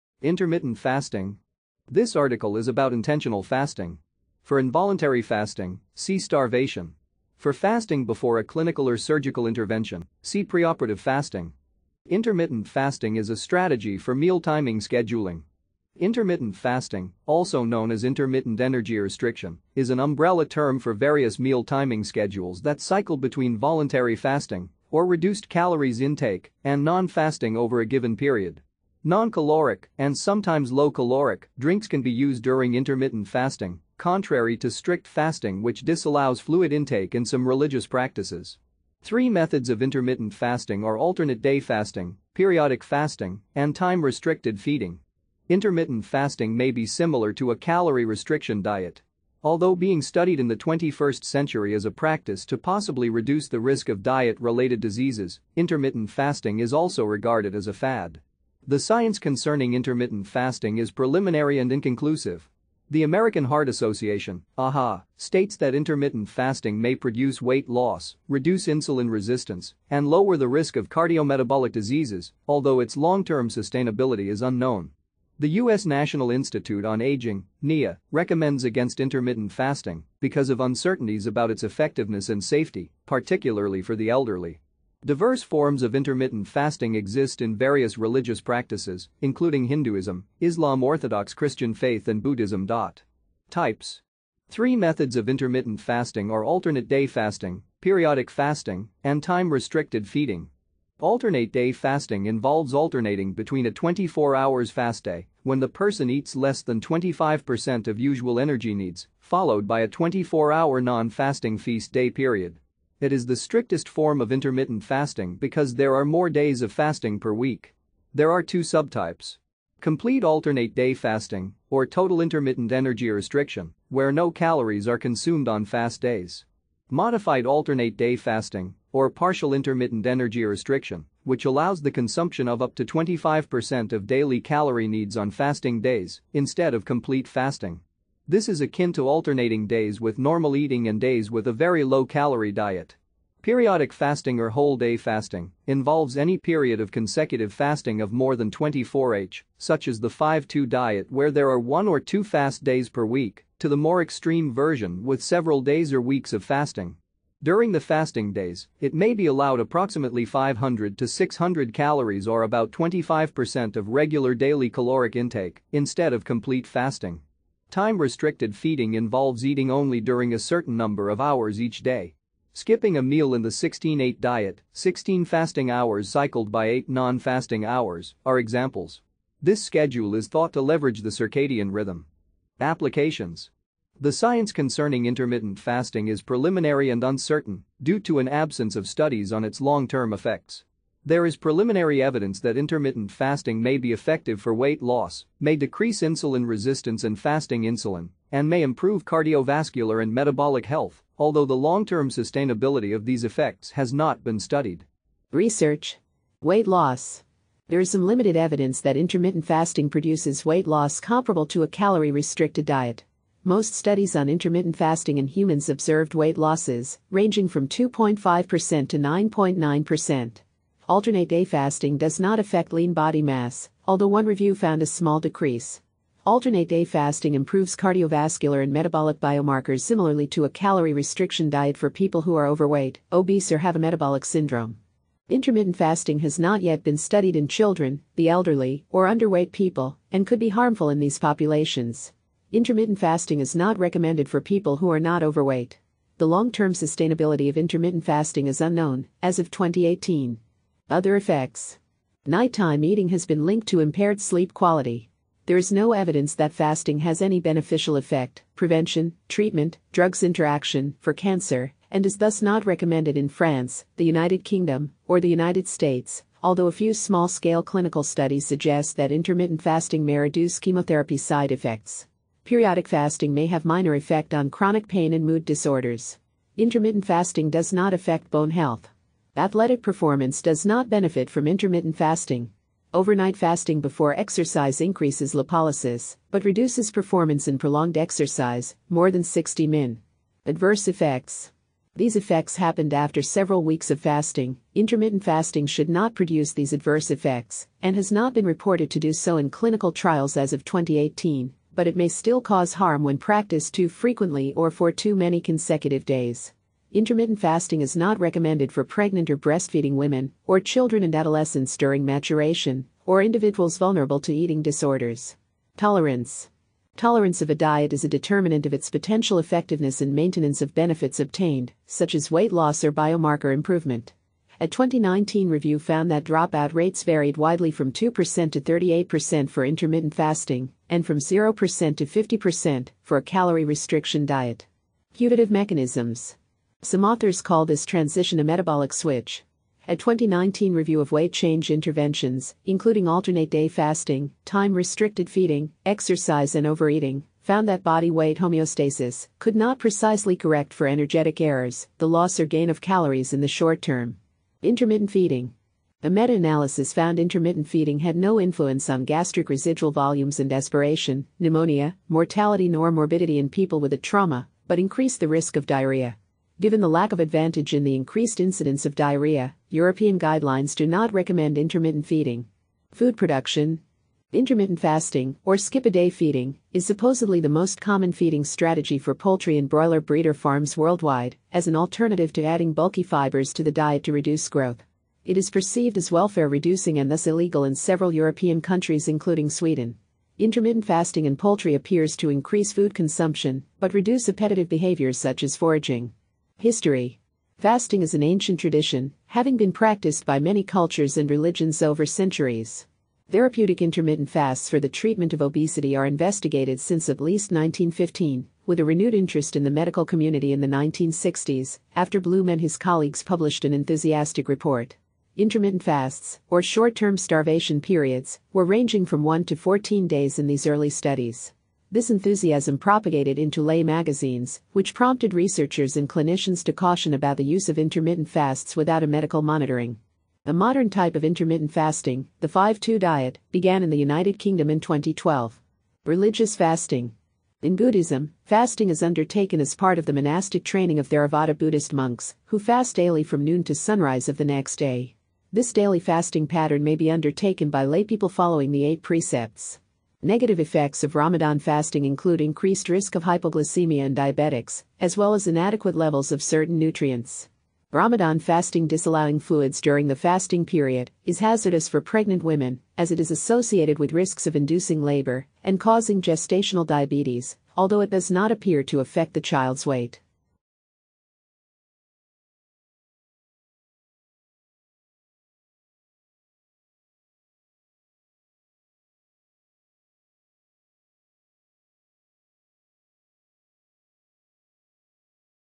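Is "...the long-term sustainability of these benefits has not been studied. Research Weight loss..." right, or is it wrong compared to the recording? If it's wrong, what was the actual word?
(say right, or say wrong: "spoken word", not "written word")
wrong: "effects", not "benefits".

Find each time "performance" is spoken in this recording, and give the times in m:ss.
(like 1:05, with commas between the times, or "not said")
4:39, 4:46.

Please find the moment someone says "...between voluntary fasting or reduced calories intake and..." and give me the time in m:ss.
0:23.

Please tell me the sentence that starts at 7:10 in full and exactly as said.
A modern type of intermittent fasting, the 5 2 diet, began in the United Kingdom in 2012.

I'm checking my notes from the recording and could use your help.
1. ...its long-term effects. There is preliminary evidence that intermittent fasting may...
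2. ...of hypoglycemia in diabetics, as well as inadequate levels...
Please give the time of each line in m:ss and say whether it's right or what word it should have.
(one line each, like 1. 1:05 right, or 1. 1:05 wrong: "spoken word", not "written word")
1. 3:09 right
2. 7:33 right.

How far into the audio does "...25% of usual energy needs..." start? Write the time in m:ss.
1:46.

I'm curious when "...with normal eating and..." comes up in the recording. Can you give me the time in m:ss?
2:19.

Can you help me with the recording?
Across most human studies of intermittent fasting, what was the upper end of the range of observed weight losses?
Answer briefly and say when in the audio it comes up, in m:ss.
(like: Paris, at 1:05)
9.9%, at 3:38.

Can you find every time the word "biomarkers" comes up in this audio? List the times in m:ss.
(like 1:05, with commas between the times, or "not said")
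3:49, 5:22.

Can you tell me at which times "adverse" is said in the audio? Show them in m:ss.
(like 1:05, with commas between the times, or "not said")
4:50, 4:56.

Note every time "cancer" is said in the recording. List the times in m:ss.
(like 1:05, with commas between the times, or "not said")
4:21.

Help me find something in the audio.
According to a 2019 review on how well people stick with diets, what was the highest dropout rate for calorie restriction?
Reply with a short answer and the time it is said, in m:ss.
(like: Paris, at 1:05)
50%, at 5:32.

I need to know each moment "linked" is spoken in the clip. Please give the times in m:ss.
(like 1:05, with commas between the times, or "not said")
4:13.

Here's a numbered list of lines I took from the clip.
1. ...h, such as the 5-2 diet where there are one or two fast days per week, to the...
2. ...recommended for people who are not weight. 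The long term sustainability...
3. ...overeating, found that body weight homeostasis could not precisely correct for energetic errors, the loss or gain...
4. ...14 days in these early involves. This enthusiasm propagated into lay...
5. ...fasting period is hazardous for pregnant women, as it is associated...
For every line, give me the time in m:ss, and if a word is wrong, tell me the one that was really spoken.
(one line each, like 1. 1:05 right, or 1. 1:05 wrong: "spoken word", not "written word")
1. 2:29 right
2. 4:03 wrong: "overweight", not "weight"
3. 5:46 right
4. 6:59 wrong: "studies", not "involves"
5. 7:40 right.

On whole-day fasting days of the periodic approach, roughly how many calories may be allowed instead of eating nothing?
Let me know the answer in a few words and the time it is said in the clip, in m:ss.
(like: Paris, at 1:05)
500 to 600, at 2:40.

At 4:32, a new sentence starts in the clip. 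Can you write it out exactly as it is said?
Periodic fasting may have minor effect on chronic pain and mood disorders.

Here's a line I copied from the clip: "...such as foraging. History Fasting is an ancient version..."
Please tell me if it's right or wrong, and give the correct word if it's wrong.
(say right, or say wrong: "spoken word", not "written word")
wrong: "tradition", not "version".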